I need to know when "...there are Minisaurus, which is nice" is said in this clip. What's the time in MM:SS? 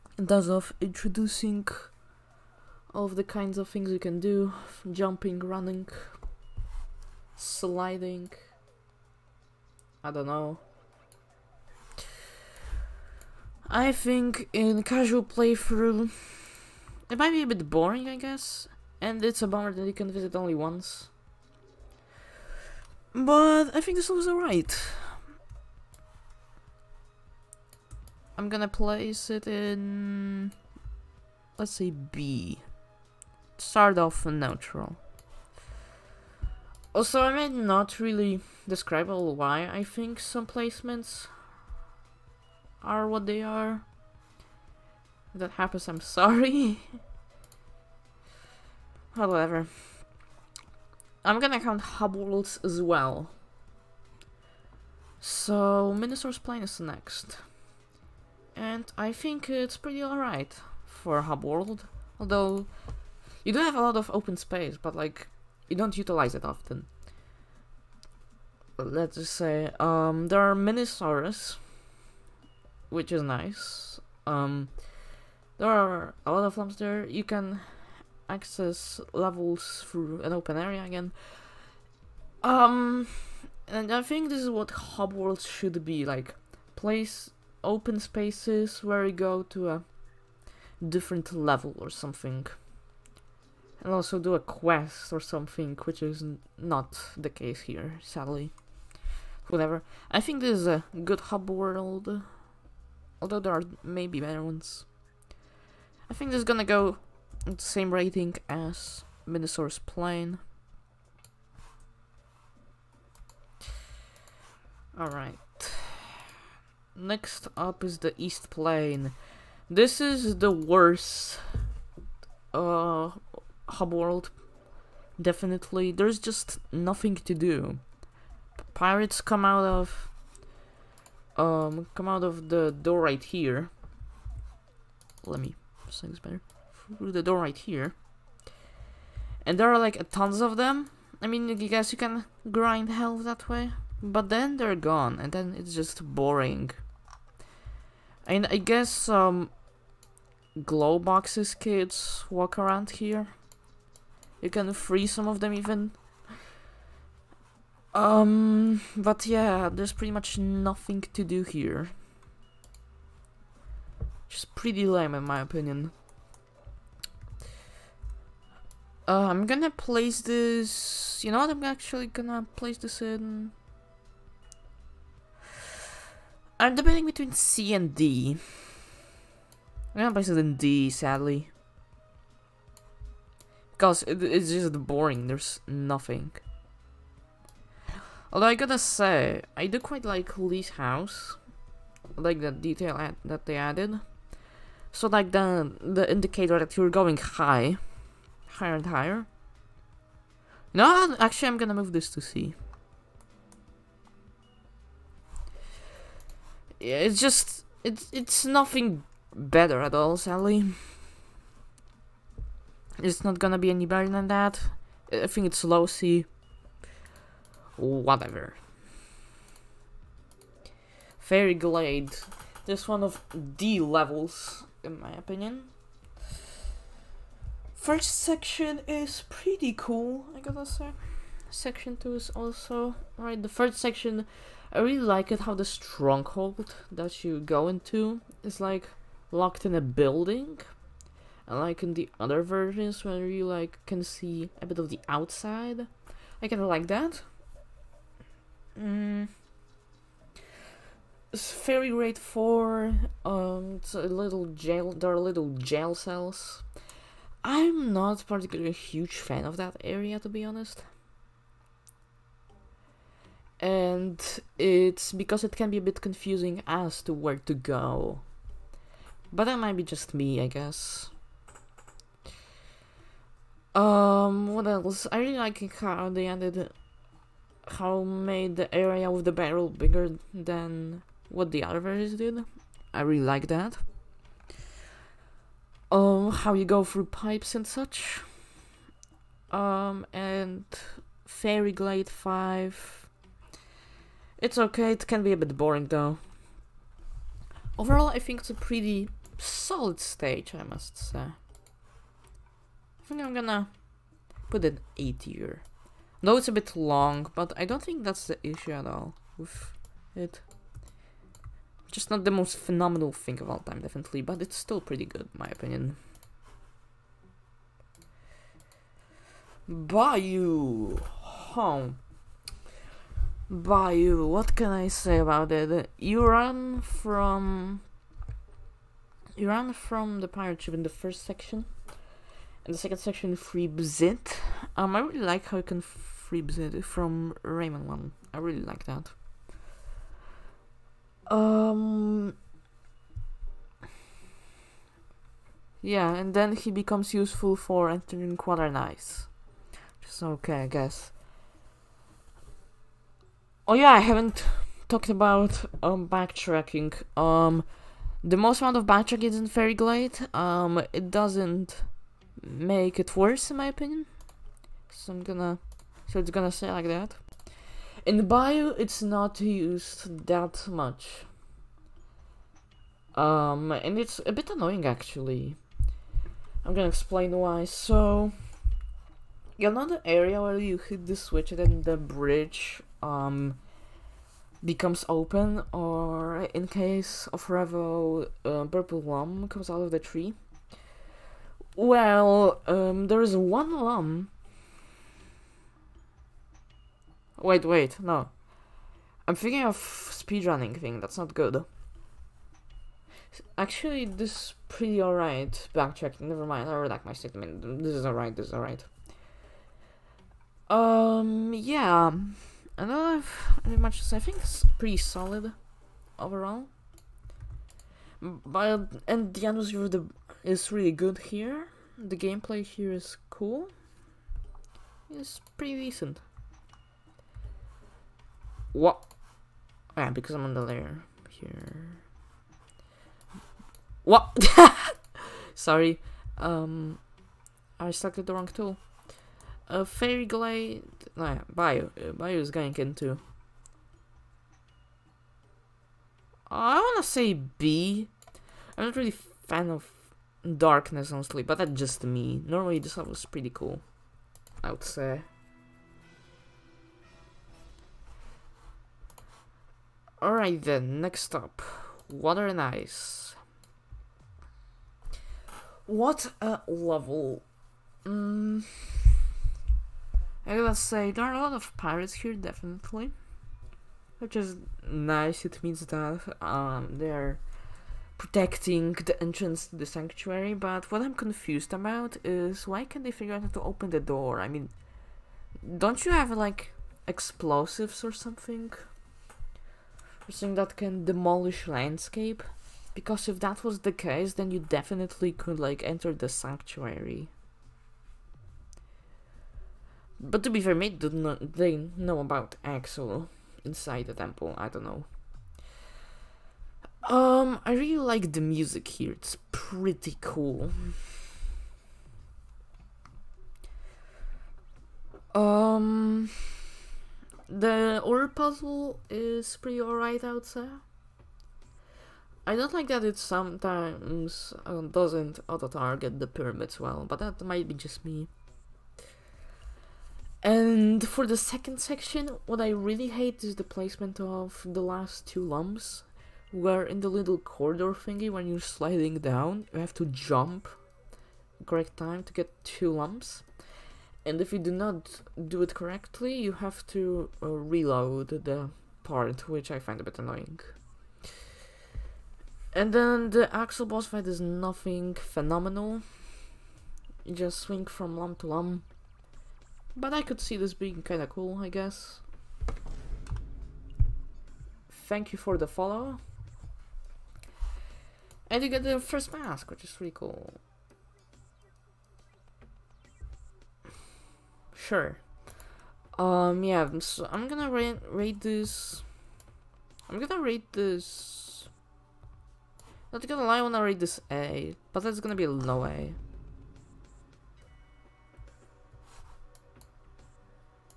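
01:10.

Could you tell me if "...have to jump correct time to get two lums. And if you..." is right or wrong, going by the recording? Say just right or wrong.
right.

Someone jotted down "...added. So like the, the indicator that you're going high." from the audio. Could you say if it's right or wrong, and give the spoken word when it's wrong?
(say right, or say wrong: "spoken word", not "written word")
right.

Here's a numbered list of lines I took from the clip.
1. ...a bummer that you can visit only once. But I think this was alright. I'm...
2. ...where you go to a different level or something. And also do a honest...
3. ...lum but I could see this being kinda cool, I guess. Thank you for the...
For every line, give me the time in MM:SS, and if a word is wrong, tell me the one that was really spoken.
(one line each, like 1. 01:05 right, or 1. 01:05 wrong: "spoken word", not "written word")
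1. 00:19 right
2. 01:28 wrong: "quest", not "honest"
3. 09:18 right.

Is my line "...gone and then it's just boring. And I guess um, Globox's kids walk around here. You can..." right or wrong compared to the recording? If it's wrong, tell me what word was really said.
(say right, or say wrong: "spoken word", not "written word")
right.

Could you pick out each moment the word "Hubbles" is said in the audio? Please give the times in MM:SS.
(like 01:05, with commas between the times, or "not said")
00:51.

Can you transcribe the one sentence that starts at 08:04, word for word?
I mean, don't you have like explosives or something?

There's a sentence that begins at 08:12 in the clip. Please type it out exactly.
Because if that was the case, then you definitely could like enter the sanctuary.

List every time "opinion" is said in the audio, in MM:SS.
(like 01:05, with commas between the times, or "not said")
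02:45, 03:45, 05:15, 06:03.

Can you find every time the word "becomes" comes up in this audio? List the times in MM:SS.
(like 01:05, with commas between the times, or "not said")
05:46, 06:24.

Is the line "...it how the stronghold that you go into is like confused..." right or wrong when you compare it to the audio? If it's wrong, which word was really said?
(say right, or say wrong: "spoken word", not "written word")
wrong: "locked", not "confused".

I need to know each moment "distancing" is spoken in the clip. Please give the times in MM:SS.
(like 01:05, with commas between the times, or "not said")
not said.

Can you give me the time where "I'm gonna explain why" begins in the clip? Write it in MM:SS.
06:16.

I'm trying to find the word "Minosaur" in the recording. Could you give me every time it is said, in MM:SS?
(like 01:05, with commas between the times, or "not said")
00:55, 01:49.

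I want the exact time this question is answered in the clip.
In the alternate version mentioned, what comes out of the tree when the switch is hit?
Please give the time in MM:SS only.
06:28.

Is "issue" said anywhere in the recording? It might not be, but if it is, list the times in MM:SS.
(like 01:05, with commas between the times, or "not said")
05:08.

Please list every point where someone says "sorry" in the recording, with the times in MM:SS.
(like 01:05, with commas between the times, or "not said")
00:46, 07:15.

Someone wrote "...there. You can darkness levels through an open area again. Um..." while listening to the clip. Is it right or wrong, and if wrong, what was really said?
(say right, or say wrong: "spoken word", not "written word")
wrong: "access", not "darkness".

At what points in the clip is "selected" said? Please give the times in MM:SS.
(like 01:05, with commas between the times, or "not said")
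07:17.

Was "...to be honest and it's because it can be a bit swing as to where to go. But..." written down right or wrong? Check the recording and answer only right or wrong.
wrong.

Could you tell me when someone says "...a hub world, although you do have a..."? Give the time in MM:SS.
01:01.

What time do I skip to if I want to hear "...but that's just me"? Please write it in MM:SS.
07:31.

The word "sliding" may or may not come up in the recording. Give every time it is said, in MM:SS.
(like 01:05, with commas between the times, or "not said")
00:07, 08:58.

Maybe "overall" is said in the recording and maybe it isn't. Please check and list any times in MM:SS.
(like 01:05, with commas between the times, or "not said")
04:57, 06:56.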